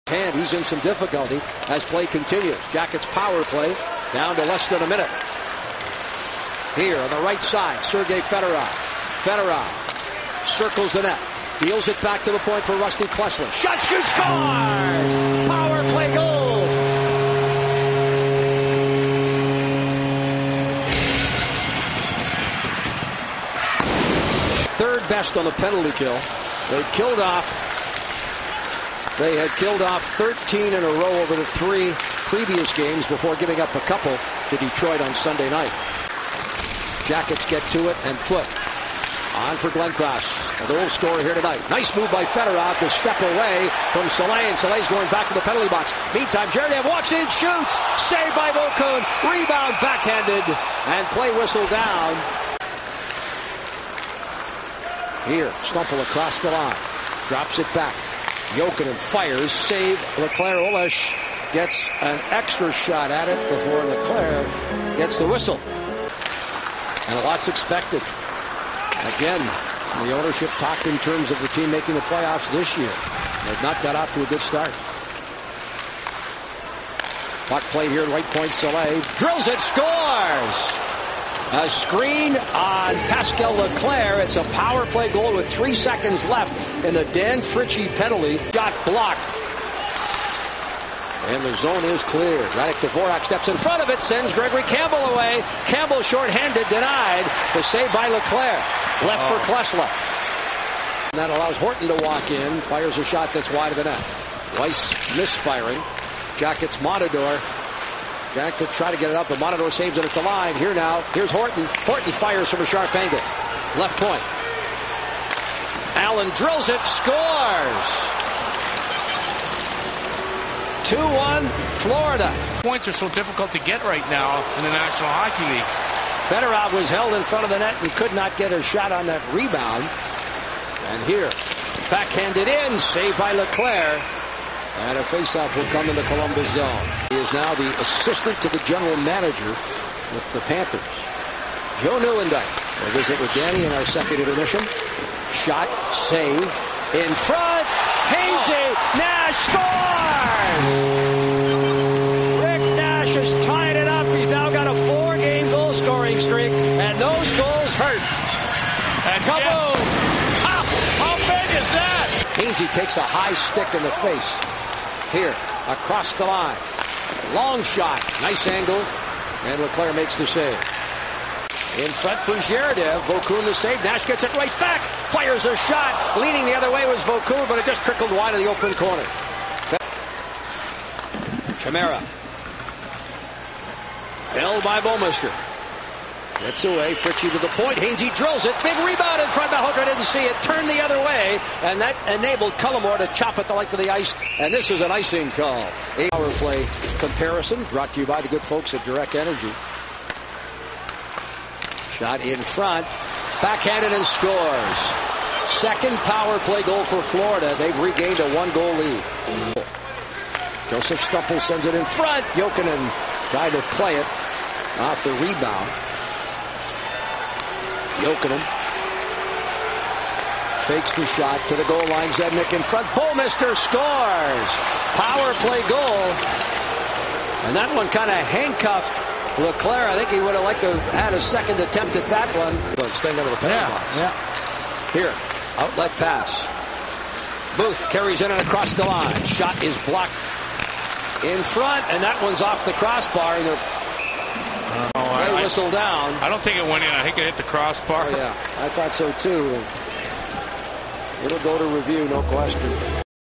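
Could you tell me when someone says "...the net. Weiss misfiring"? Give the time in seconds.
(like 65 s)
103 s.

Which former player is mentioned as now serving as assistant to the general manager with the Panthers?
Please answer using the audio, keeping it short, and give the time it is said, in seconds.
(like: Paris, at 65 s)
Joe Nieuwendyk, at 141 s.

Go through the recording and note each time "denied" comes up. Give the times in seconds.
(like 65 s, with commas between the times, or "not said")
96 s.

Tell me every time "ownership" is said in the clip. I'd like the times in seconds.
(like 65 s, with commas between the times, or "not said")
70 s.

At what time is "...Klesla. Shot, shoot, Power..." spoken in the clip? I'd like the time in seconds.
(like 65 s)
13 s.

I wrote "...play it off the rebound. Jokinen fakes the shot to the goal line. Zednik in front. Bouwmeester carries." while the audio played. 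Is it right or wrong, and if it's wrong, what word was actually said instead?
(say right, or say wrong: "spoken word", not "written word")
wrong: "scores", not "carries".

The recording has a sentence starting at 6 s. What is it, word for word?
Here on the right side, Sergei Fedorov.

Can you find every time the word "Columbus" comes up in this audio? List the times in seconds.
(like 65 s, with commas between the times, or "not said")
136 s.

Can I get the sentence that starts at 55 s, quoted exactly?
Here, Stumpel across the line, drops it back, Jokinen fires, save.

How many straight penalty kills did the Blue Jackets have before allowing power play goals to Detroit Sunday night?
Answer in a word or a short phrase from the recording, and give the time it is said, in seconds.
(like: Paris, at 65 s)
13, at 30 s.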